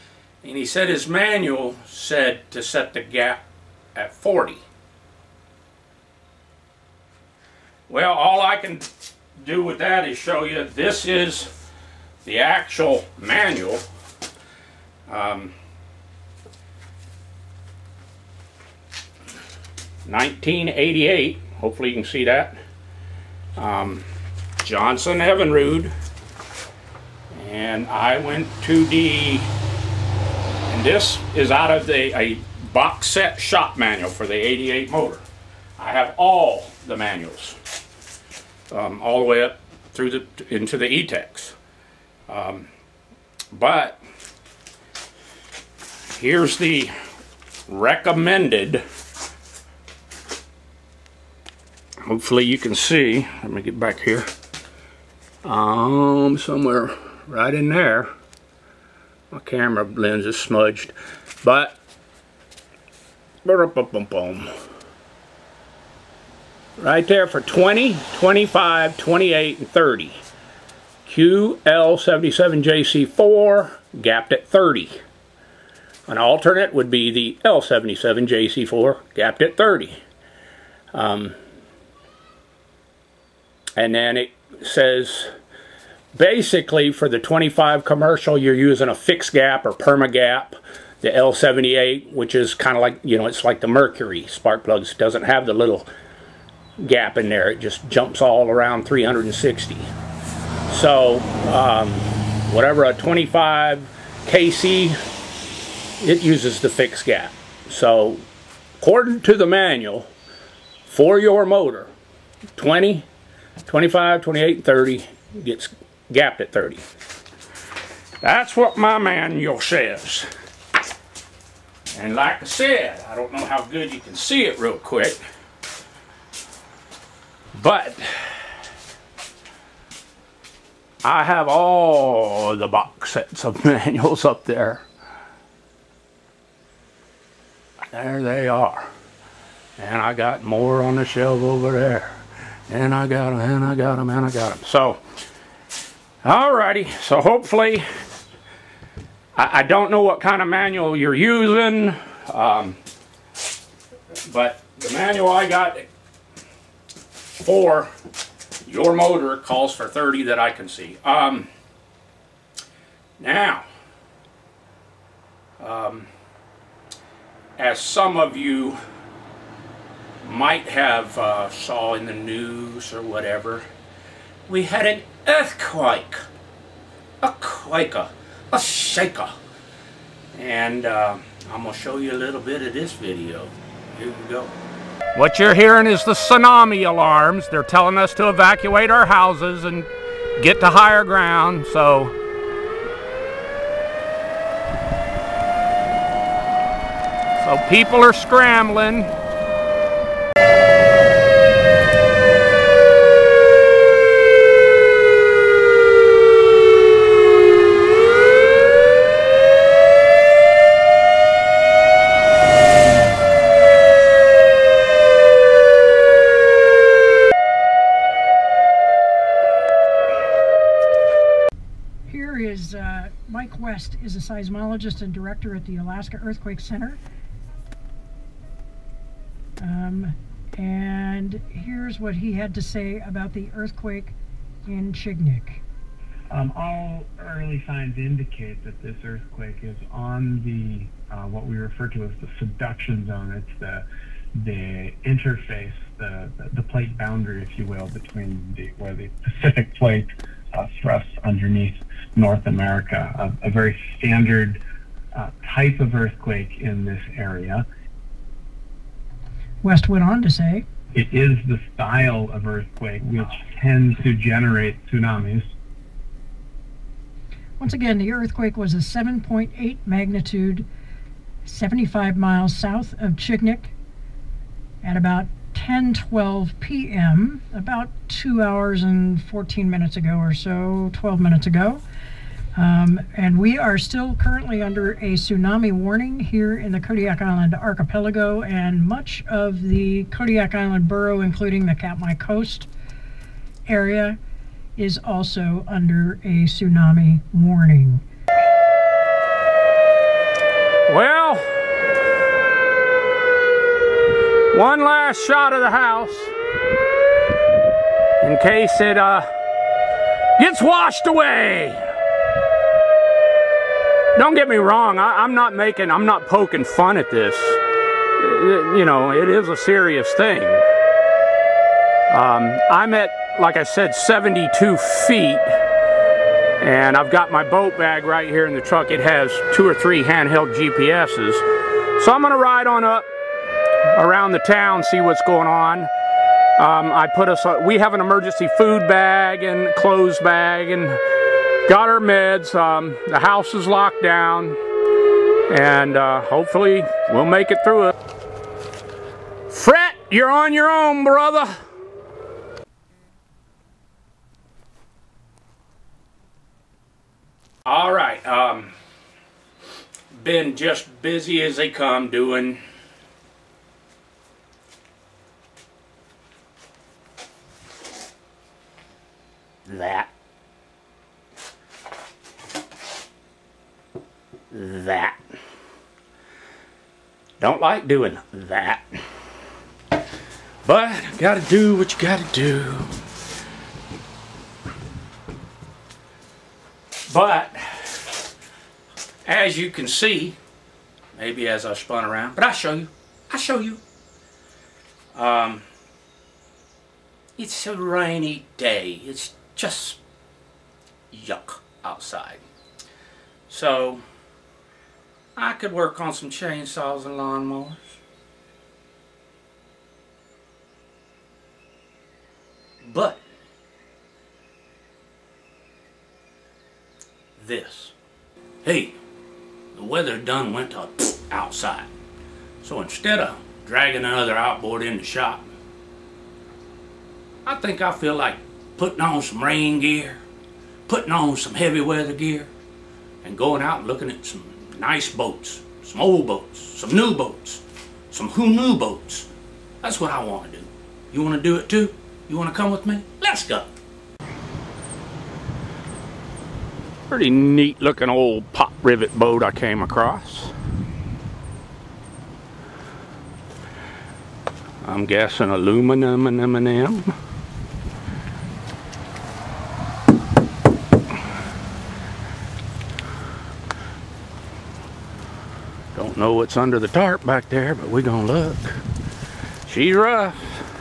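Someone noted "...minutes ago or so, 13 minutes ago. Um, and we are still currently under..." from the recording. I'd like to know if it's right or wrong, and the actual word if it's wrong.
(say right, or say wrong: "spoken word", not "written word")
wrong: "12", not "13".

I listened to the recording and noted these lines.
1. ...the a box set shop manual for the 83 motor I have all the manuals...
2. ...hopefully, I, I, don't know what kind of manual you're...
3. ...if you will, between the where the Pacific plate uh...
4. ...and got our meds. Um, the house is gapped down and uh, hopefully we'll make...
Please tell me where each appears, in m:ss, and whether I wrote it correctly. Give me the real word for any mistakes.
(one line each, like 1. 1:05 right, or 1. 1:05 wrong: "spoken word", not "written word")
1. 0:31 wrong: "88", not "83"
2. 2:27 right
3. 4:07 right
4. 5:40 wrong: "locked", not "gapped".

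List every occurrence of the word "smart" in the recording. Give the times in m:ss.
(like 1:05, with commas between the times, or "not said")
not said.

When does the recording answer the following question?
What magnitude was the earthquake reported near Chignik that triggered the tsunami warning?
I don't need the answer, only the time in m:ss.
4:28.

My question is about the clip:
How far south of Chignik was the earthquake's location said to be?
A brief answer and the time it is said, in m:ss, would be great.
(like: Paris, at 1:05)
75 miles, at 4:31.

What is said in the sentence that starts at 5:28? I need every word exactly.
It has two or three handheld GPSs.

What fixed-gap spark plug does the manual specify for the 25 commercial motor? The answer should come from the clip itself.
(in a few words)
L78.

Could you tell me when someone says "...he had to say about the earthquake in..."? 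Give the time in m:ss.
3:52.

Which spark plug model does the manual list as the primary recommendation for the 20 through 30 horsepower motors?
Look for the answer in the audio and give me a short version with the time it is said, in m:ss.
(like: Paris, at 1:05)
QL77JC4, at 1:11.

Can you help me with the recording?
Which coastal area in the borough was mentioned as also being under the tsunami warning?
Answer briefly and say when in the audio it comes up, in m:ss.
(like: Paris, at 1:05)
Katmai Coast, at 4:51.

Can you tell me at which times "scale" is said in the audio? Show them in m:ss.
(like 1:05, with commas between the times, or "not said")
not said.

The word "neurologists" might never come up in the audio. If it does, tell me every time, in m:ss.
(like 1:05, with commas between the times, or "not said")
not said.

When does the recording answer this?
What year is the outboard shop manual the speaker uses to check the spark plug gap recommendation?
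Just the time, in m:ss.
0:20.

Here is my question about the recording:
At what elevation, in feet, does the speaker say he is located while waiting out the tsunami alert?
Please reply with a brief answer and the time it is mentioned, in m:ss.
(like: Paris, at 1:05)
72 feet, at 5:23.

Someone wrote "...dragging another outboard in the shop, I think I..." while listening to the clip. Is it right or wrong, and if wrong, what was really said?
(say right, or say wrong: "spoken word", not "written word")
right.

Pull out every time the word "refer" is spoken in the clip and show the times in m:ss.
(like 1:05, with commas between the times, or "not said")
4:01.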